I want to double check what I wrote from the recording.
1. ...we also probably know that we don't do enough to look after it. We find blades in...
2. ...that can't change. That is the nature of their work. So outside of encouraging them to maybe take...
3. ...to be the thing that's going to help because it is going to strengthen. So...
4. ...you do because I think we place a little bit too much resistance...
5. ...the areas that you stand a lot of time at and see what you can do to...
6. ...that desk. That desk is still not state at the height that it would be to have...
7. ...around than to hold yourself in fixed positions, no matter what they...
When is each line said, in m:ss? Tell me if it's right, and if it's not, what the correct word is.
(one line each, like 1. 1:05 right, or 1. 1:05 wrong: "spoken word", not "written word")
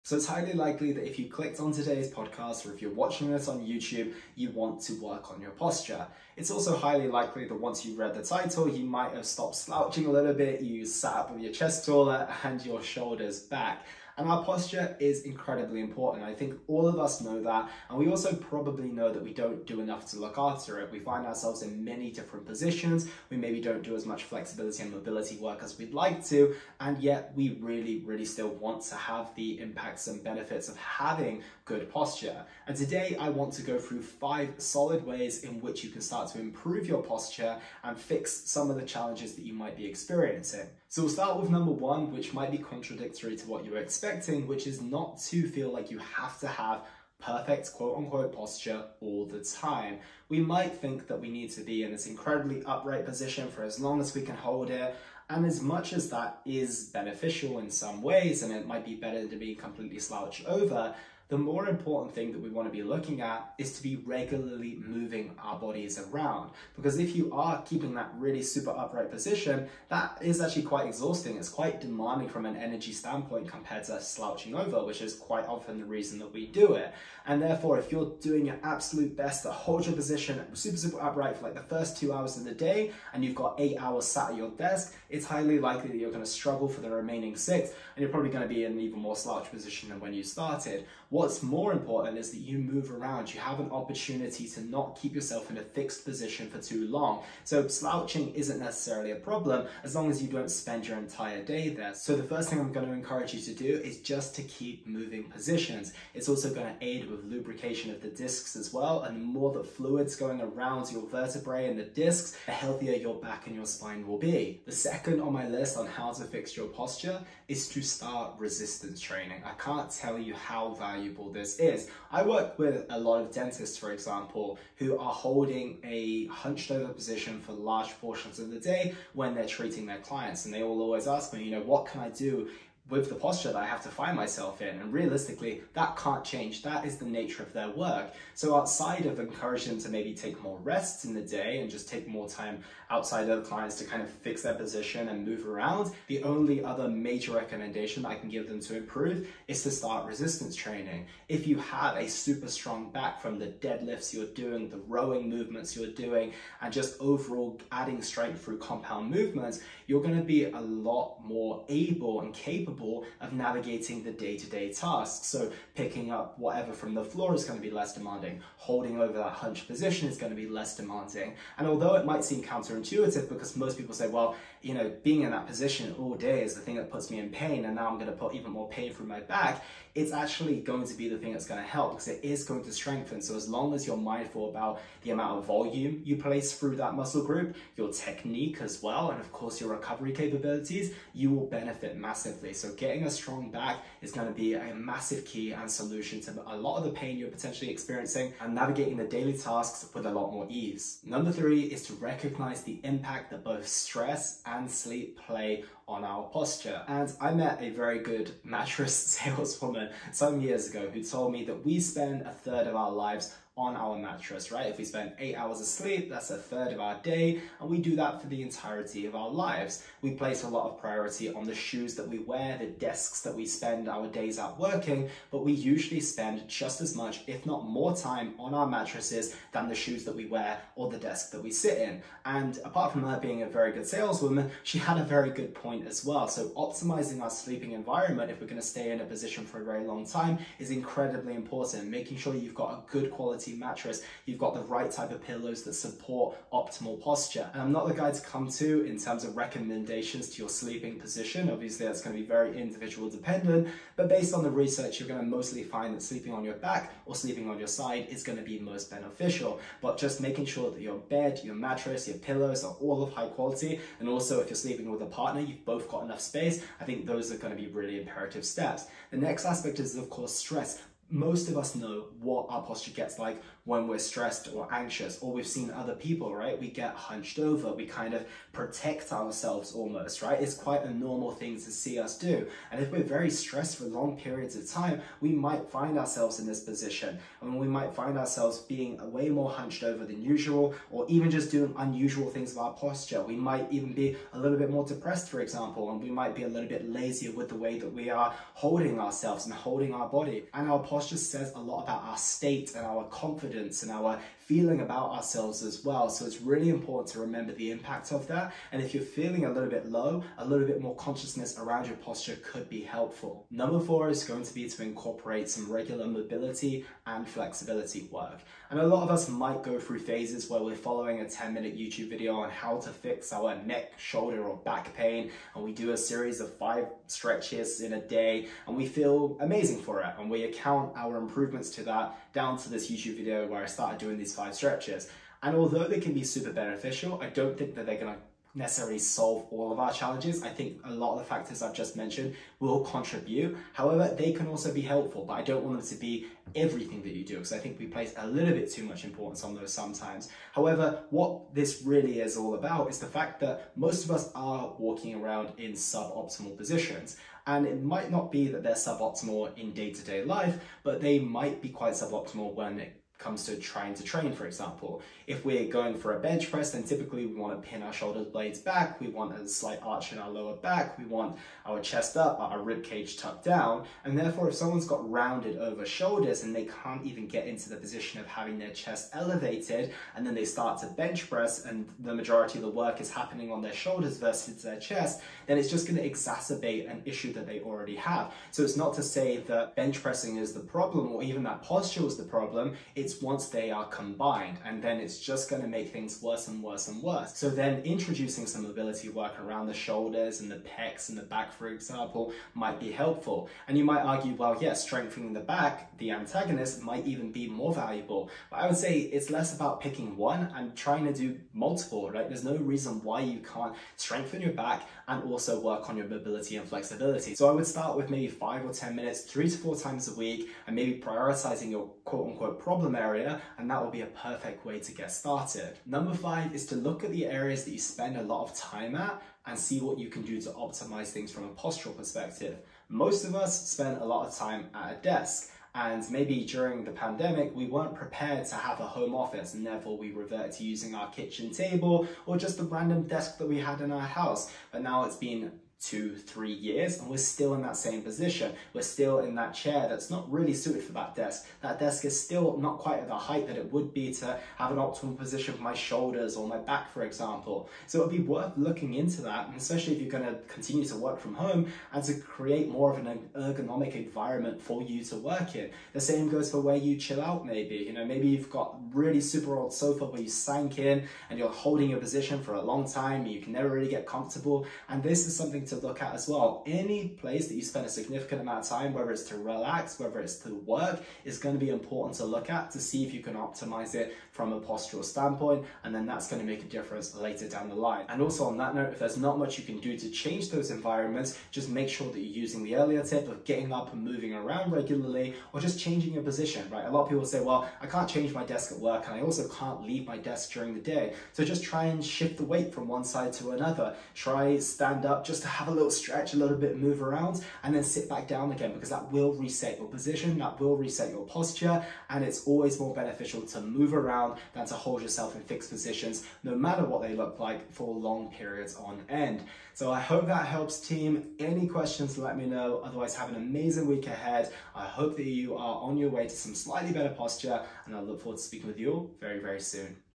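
1. 0:17 wrong: "ourselves", not "blades"
2. 2:15 right
3. 3:00 right
4. 5:47 wrong: "importance", not "resistance"
5. 7:07 wrong: "spend", not "stand"
6. 7:30 wrong: "quite", not "state"
7. 8:33 right.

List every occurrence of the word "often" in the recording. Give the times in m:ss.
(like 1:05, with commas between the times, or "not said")
1:15.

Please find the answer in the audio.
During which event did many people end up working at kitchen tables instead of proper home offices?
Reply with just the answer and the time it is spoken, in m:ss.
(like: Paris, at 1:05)
The pandemic, at 7:16.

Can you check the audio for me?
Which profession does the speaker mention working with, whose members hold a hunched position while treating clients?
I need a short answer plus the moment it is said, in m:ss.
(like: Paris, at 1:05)
Dentists, at 2:03.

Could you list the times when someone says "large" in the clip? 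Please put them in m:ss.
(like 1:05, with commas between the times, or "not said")
2:07.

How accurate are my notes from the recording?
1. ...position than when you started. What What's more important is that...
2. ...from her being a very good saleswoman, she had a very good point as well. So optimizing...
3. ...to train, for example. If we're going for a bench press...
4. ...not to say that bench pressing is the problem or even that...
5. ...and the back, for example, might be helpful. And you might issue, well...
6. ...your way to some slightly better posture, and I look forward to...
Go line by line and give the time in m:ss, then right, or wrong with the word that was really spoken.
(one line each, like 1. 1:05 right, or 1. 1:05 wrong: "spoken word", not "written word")
1. 1:29 right
2. 3:52 right
3. 6:03 right
4. 6:28 right
5. 6:41 wrong: "argue", not "issue"
6. 8:45 right.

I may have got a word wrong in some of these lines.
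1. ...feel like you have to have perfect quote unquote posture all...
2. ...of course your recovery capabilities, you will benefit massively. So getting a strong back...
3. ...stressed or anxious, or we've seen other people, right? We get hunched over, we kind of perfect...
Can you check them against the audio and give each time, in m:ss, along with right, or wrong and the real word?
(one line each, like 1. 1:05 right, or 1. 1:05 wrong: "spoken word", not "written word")
1. 0:45 right
2. 3:09 right
3. 4:33 wrong: "protect", not "perfect".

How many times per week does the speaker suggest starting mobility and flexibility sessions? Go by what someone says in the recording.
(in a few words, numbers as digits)
3 to 4.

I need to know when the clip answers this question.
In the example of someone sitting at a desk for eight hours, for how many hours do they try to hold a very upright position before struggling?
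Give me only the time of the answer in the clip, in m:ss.
1:21.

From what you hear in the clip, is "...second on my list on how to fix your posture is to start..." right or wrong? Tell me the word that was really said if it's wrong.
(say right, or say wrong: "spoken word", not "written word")
right.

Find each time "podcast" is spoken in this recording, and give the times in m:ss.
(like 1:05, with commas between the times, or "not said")
0:02.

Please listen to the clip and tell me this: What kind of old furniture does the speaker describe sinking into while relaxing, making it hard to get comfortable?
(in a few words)
Sofa.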